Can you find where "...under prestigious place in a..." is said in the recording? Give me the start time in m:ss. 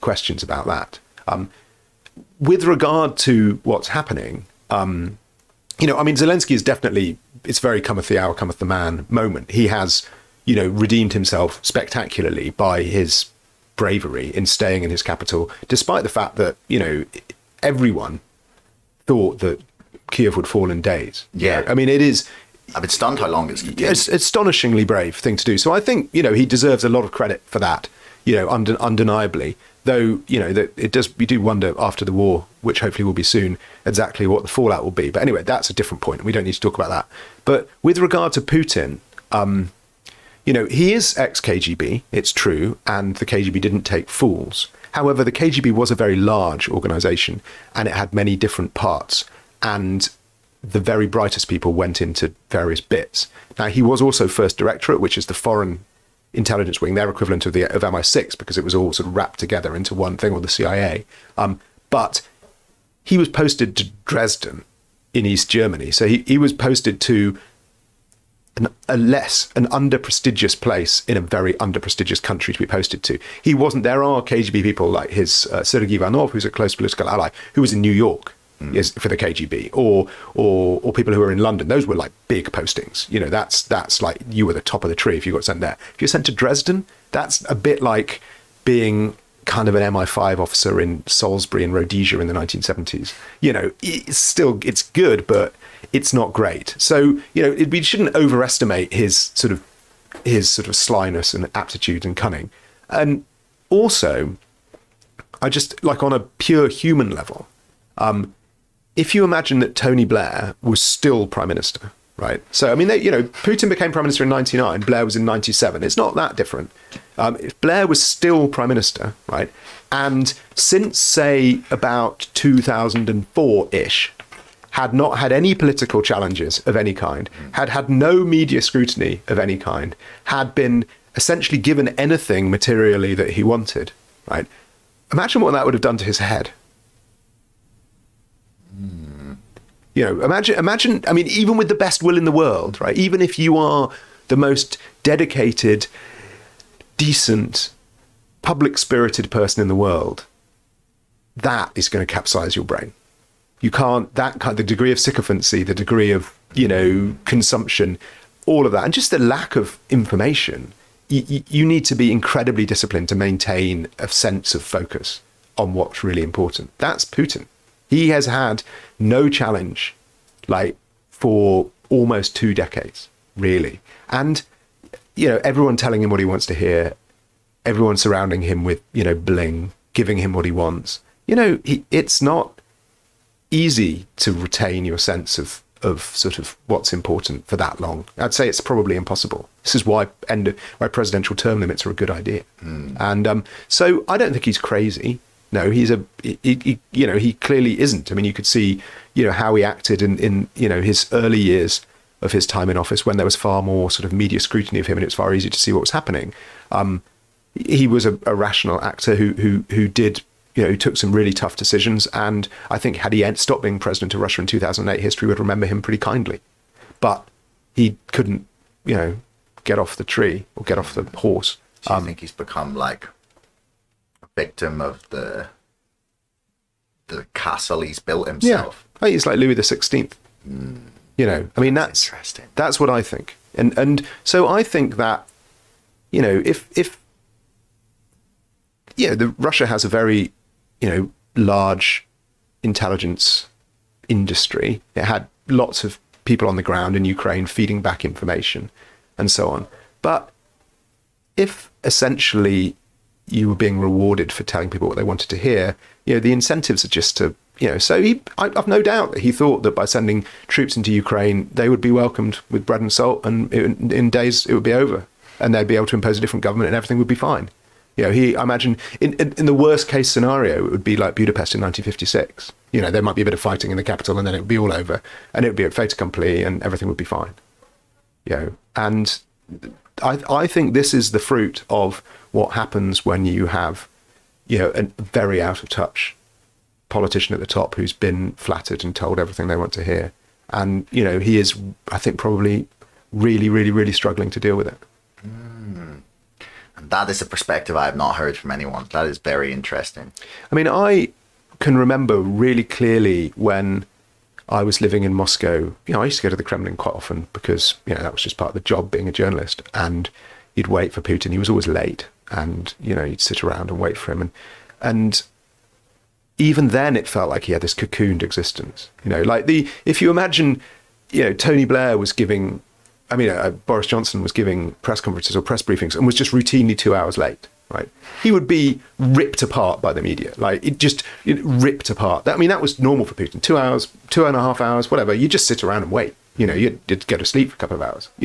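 1:09.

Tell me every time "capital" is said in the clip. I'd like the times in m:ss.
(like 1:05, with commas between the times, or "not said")
0:15, 4:33.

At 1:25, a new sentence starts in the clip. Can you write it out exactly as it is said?
If you're sent to Dresden, that's a bit like being kind of an MI5 officer in Salisbury and Rhodesia in the 1970s.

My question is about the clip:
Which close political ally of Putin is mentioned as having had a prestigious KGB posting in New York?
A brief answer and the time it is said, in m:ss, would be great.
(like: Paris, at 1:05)
Sergei Ivanov, at 1:15.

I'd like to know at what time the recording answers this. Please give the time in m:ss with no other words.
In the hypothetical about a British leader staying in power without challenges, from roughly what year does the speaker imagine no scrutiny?
2:02.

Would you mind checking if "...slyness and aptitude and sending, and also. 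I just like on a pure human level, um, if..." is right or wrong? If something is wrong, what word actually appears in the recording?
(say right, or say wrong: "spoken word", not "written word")
wrong: "cunning", not "sending".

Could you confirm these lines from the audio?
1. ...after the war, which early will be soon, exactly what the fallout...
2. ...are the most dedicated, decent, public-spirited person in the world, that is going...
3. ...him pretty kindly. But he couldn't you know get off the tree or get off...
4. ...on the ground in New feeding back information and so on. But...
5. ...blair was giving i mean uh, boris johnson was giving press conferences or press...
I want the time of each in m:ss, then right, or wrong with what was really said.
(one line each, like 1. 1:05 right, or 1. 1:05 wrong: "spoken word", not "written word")
1. 0:31 wrong: "hopefully", not "early"
2. 2:23 right
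3. 3:35 right
4. 4:06 wrong: "Ukraine", not "New"
5. 5:21 right.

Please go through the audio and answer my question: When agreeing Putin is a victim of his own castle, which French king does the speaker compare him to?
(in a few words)
Louis the Sixteenth.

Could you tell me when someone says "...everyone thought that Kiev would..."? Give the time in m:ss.
0:17.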